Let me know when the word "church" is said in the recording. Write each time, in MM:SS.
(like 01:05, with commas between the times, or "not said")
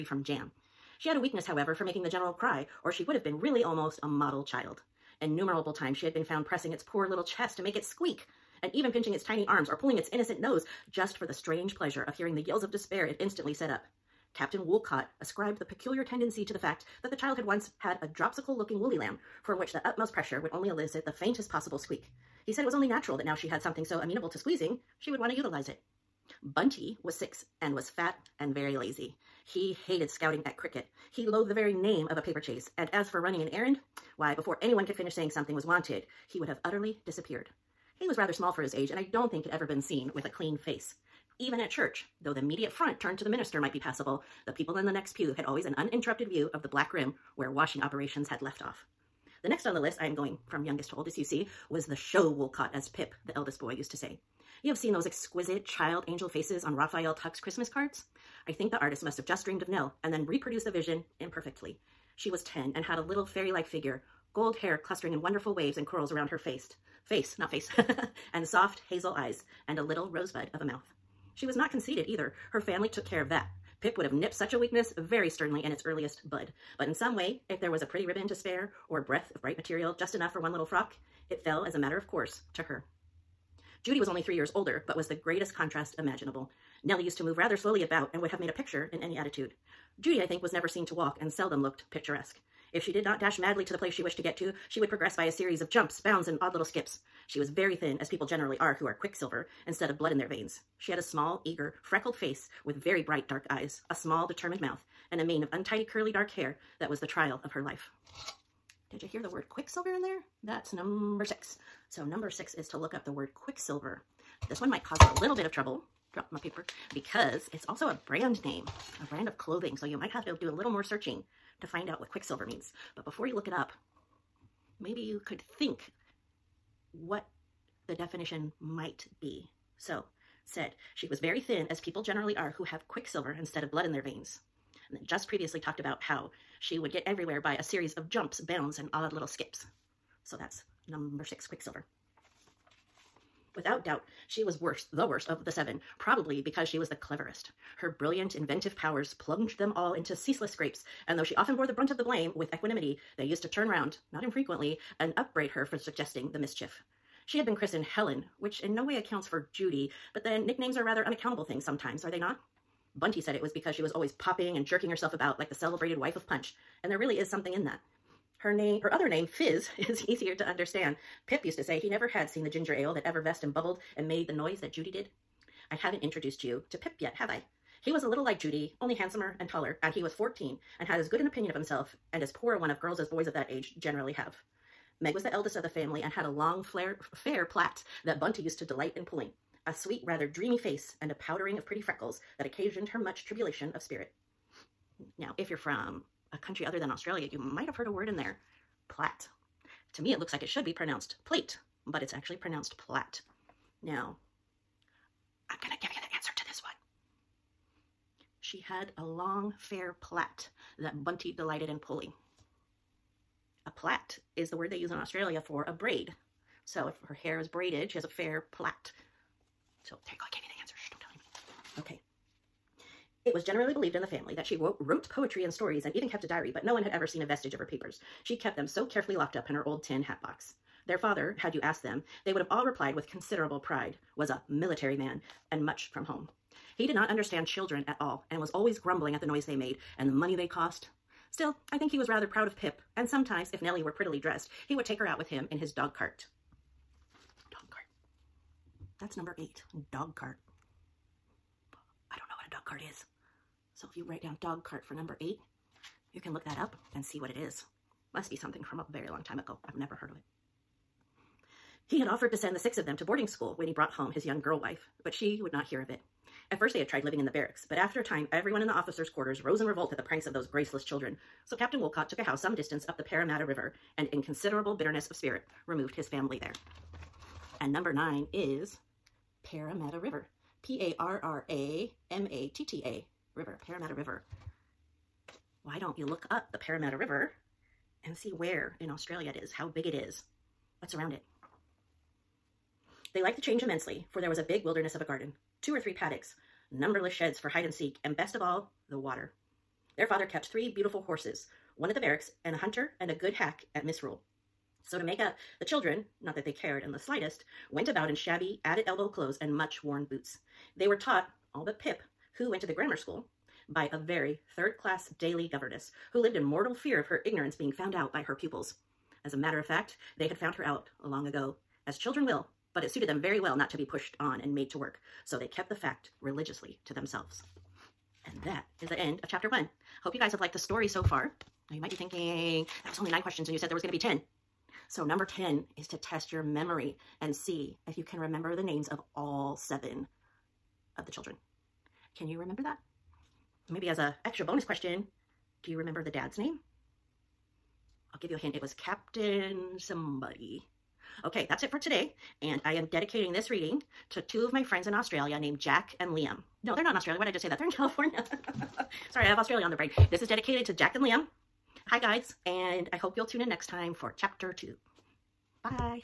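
00:41.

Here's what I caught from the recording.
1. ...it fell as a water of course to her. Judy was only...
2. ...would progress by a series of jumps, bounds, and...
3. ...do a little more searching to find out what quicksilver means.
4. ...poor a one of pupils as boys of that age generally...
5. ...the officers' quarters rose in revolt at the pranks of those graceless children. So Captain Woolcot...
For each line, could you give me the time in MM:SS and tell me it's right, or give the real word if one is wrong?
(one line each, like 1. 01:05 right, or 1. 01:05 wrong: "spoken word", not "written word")
1. 01:21 wrong: "matter", not "water"
2. 01:34 right
3. 02:00 right
4. 03:02 wrong: "girls", not "pupils"
5. 04:28 right.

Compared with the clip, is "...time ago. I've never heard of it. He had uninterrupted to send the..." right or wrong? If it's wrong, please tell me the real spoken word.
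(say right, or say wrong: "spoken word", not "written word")
wrong: "offered", not "uninterrupted".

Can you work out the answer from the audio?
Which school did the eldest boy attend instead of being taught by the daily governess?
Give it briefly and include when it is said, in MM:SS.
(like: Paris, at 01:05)
the grammar school, at 05:12.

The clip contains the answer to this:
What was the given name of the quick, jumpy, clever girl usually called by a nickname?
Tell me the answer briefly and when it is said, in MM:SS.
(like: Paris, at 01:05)
Helen, at 02:37.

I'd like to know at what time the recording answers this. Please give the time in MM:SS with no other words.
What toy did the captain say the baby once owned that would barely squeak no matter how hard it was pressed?
00:18.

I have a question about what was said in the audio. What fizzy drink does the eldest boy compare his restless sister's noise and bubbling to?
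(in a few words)
ginger ale.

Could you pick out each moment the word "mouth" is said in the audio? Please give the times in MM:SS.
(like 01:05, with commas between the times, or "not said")
01:10, 01:44.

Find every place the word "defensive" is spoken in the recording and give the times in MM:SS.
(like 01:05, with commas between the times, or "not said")
not said.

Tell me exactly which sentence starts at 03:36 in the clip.
So if her hair is braided, she has a fair plait.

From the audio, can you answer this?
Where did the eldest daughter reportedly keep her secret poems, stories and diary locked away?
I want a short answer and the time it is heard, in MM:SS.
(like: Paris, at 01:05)
old tin hat box, at 03:49.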